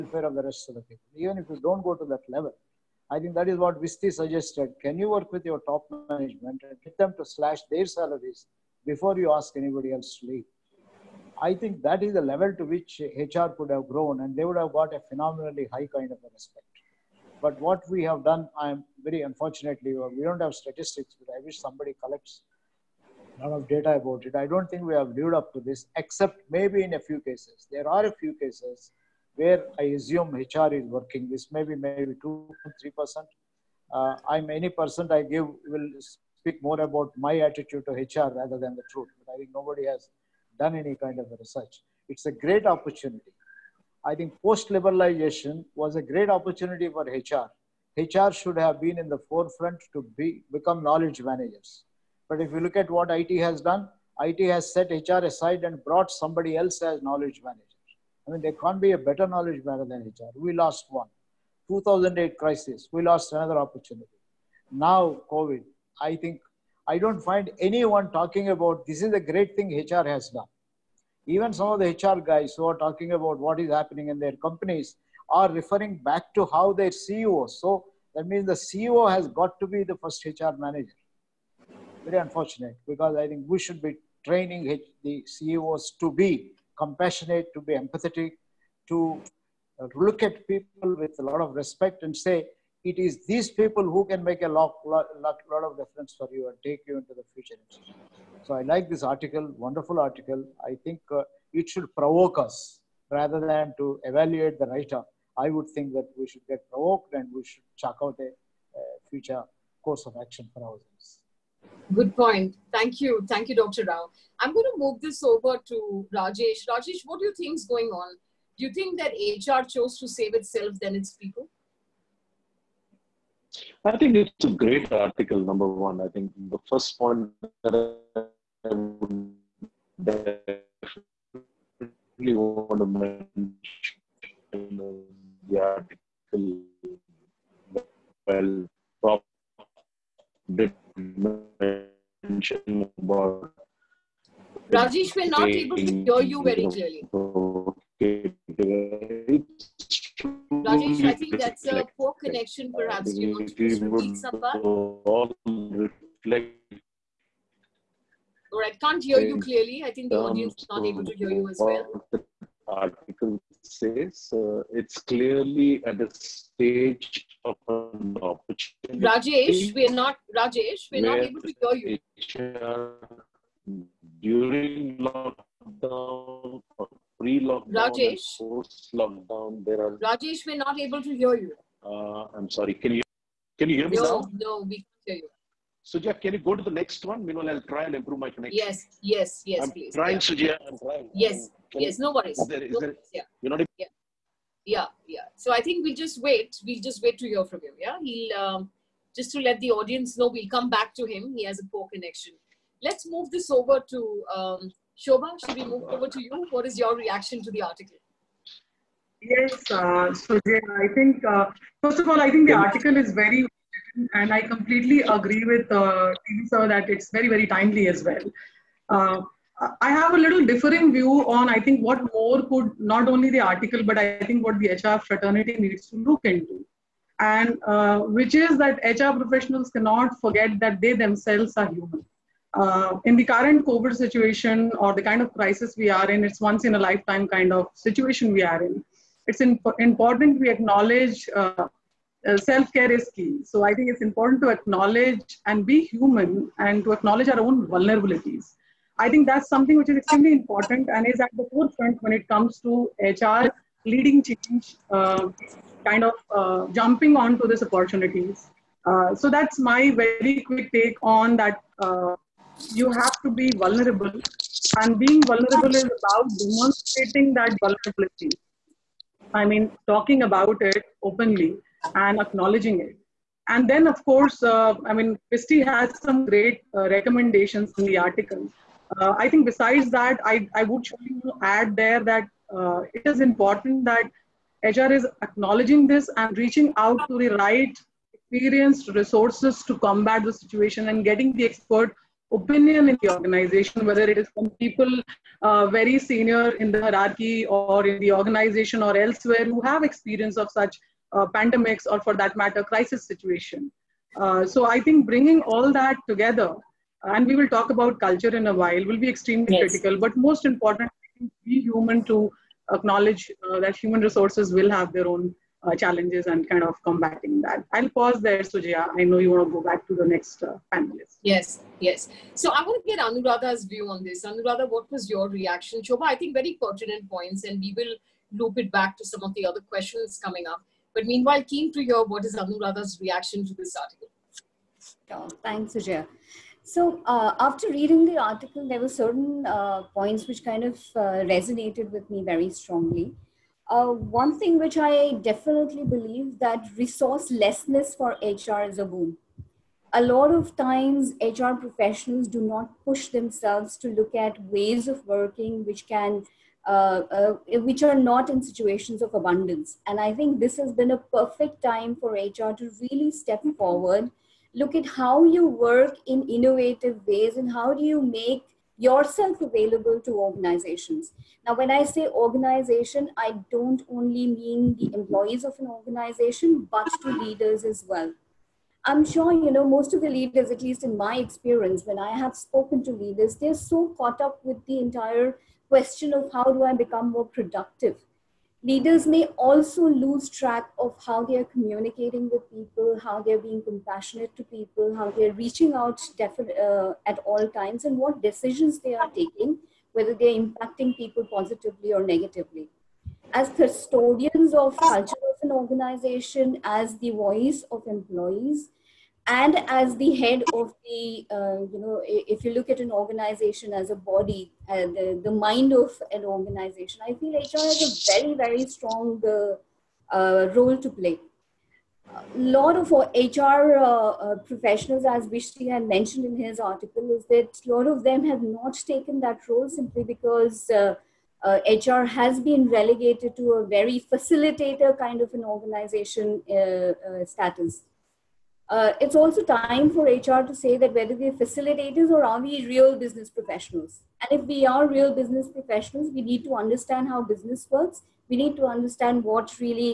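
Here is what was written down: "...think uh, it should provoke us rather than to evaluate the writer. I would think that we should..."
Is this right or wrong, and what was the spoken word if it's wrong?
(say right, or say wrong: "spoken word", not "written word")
right.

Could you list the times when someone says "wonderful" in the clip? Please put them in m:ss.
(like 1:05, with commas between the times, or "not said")
1:39.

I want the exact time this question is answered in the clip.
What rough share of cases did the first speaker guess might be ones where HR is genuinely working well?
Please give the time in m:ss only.
0:32.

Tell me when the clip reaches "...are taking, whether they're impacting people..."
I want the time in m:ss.
6:38.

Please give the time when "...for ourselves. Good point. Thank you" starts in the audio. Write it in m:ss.
1:50.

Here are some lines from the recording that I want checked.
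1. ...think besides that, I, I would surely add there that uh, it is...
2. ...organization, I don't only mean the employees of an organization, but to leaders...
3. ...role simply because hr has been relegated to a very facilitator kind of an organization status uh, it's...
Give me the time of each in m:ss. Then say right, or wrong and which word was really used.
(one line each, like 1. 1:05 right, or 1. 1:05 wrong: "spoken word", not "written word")
1. 4:39 right
2. 6:12 right
3. 7:09 right.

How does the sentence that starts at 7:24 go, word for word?
And if we are real business professionals, we need to understand how business works.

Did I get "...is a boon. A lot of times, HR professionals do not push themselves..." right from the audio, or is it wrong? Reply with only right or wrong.
right.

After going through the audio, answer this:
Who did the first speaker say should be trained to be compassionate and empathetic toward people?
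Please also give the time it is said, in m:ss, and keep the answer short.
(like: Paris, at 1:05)
CEOs, at 1:25.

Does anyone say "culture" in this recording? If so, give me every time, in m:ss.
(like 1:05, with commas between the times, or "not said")
5:07, 6:44.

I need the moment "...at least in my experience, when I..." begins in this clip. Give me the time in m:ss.
6:20.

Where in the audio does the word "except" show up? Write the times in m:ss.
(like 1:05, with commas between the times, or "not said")
0:25.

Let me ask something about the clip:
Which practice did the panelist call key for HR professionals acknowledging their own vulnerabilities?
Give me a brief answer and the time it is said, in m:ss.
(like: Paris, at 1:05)
Self care, at 4:02.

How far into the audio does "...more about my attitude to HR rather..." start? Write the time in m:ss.
0:36.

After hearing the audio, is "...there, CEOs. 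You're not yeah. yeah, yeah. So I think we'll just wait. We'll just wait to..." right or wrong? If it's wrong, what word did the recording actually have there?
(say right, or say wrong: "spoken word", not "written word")
wrong: "Yeah", not "CEOs".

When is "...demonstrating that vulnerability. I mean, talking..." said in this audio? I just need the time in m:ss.
4:26.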